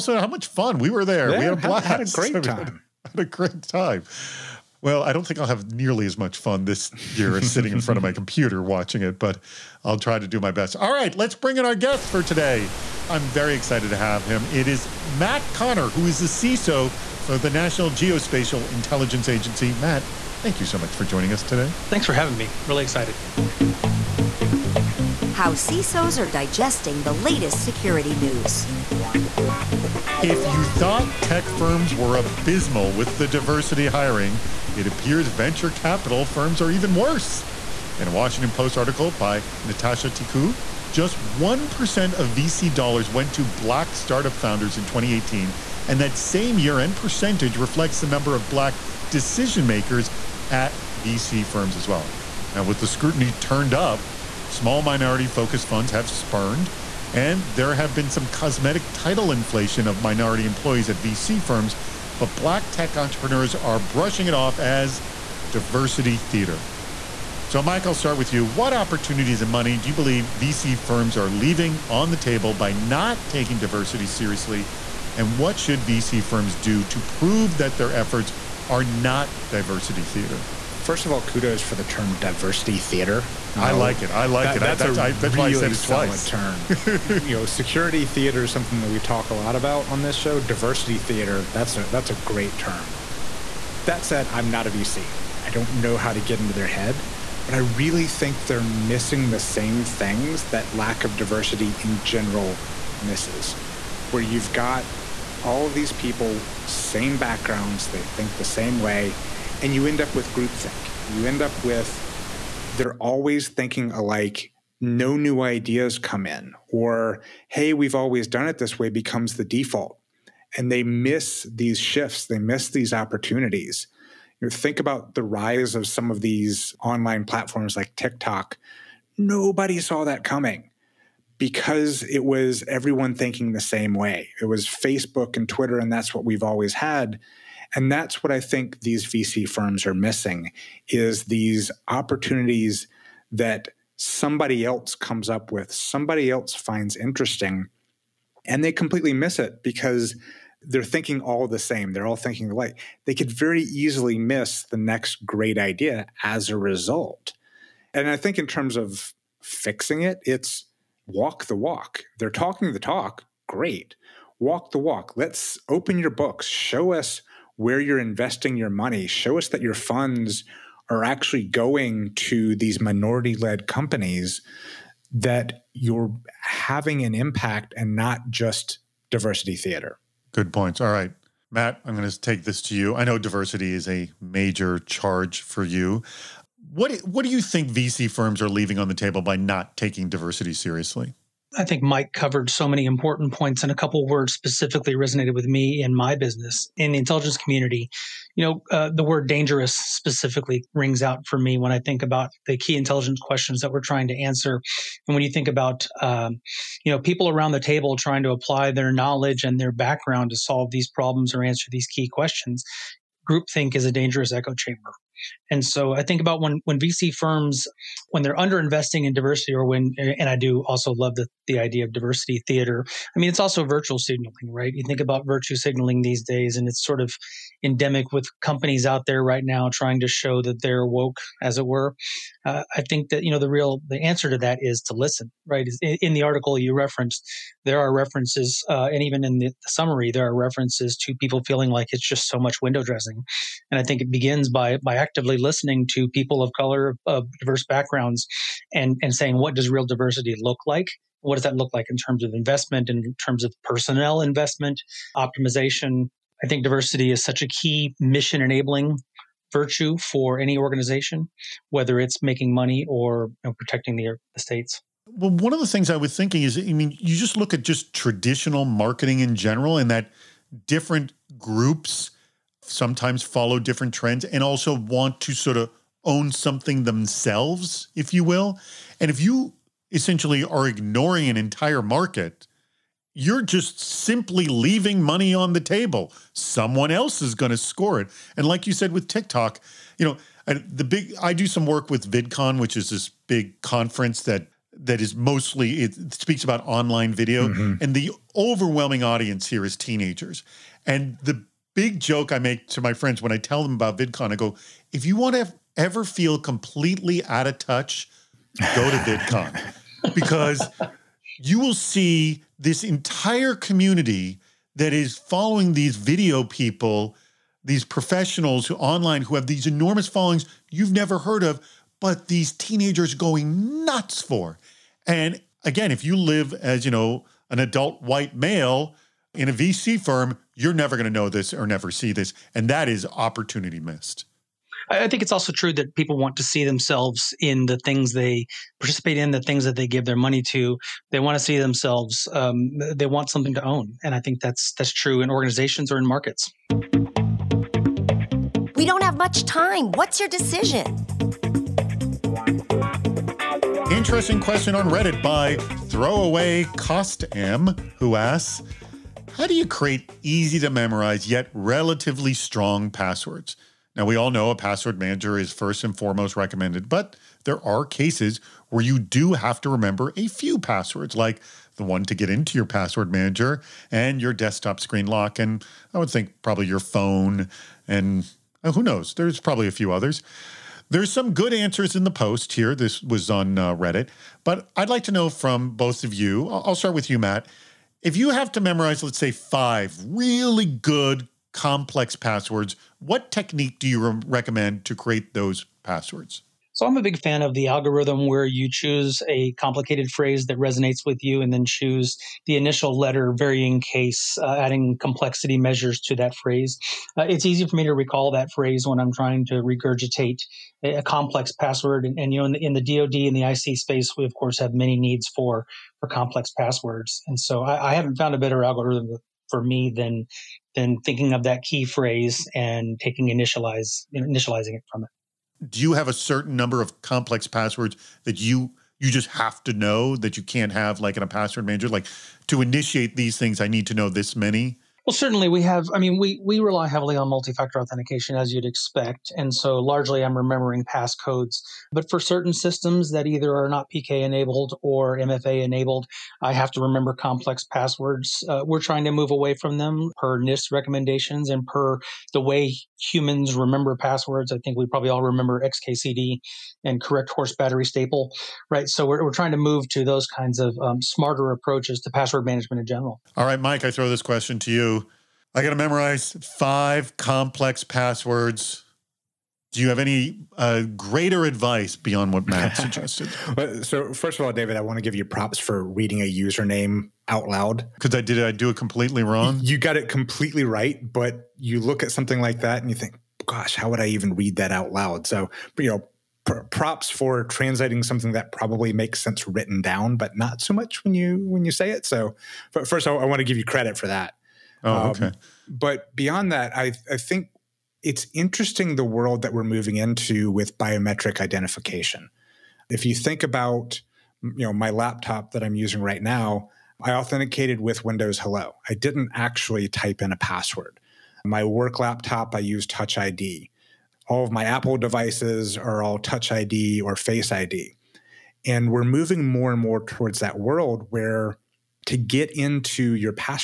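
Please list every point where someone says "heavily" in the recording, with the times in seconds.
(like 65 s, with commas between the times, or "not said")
436 s.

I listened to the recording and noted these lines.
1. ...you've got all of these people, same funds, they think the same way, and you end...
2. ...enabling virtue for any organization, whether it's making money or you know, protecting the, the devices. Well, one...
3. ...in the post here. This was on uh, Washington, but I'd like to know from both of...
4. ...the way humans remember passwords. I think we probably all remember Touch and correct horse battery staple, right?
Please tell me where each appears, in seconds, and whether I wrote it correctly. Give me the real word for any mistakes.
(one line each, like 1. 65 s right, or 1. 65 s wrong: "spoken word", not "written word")
1. 104 s wrong: "backgrounds", not "funds"
2. 258 s wrong: "states", not "devices"
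3. 381 s wrong: "Reddit", not "Washington"
4. 452 s wrong: "XKCD", not "Touch".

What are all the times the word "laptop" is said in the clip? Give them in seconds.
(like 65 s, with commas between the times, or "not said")
504 s, 511 s.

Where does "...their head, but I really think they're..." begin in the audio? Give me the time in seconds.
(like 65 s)
96 s.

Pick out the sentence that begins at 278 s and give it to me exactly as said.
And if you essentially are ignoring an entire market, you're just simply leaving money on the table.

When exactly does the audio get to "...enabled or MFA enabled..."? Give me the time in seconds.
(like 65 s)
444 s.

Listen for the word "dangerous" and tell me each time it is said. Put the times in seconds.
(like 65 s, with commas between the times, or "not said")
199 s, 213 s.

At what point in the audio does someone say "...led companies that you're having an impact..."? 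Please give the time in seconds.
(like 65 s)
173 s.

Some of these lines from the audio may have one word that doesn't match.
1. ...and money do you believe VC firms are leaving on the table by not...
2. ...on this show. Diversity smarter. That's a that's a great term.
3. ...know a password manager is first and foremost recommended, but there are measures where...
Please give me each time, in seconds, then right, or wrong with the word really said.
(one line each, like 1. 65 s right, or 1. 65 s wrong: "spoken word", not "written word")
1. 69 s right
2. 89 s wrong: "theater", not "smarter"
3. 364 s wrong: "cases", not "measures".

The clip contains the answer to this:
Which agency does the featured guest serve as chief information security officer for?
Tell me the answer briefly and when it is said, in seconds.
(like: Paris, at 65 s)
National Geospatial Intelligence Agency, at 17 s.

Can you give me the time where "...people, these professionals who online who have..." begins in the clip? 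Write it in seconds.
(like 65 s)
316 s.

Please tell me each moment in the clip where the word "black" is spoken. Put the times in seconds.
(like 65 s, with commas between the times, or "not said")
43 s, 48 s, 62 s.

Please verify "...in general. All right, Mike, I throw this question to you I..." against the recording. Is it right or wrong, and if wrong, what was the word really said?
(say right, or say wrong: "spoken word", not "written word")
right.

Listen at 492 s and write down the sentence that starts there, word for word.
So, first, I, I want to give you credit for that.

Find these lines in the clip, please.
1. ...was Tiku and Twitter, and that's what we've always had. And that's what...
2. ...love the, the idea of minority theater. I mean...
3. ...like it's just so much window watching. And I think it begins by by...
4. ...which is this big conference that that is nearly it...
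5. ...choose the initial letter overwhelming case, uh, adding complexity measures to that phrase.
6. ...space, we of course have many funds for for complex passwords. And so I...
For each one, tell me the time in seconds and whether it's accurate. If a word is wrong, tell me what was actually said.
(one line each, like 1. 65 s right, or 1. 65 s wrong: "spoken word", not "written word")
1. 134 s wrong: "Facebook", not "Tiku"
2. 220 s wrong: "diversity", not "minority"
3. 241 s wrong: "dressing", not "watching"
4. 292 s wrong: "mostly", not "nearly"
5. 401 s wrong: "varying", not "overwhelming"
6. 413 s wrong: "needs", not "funds".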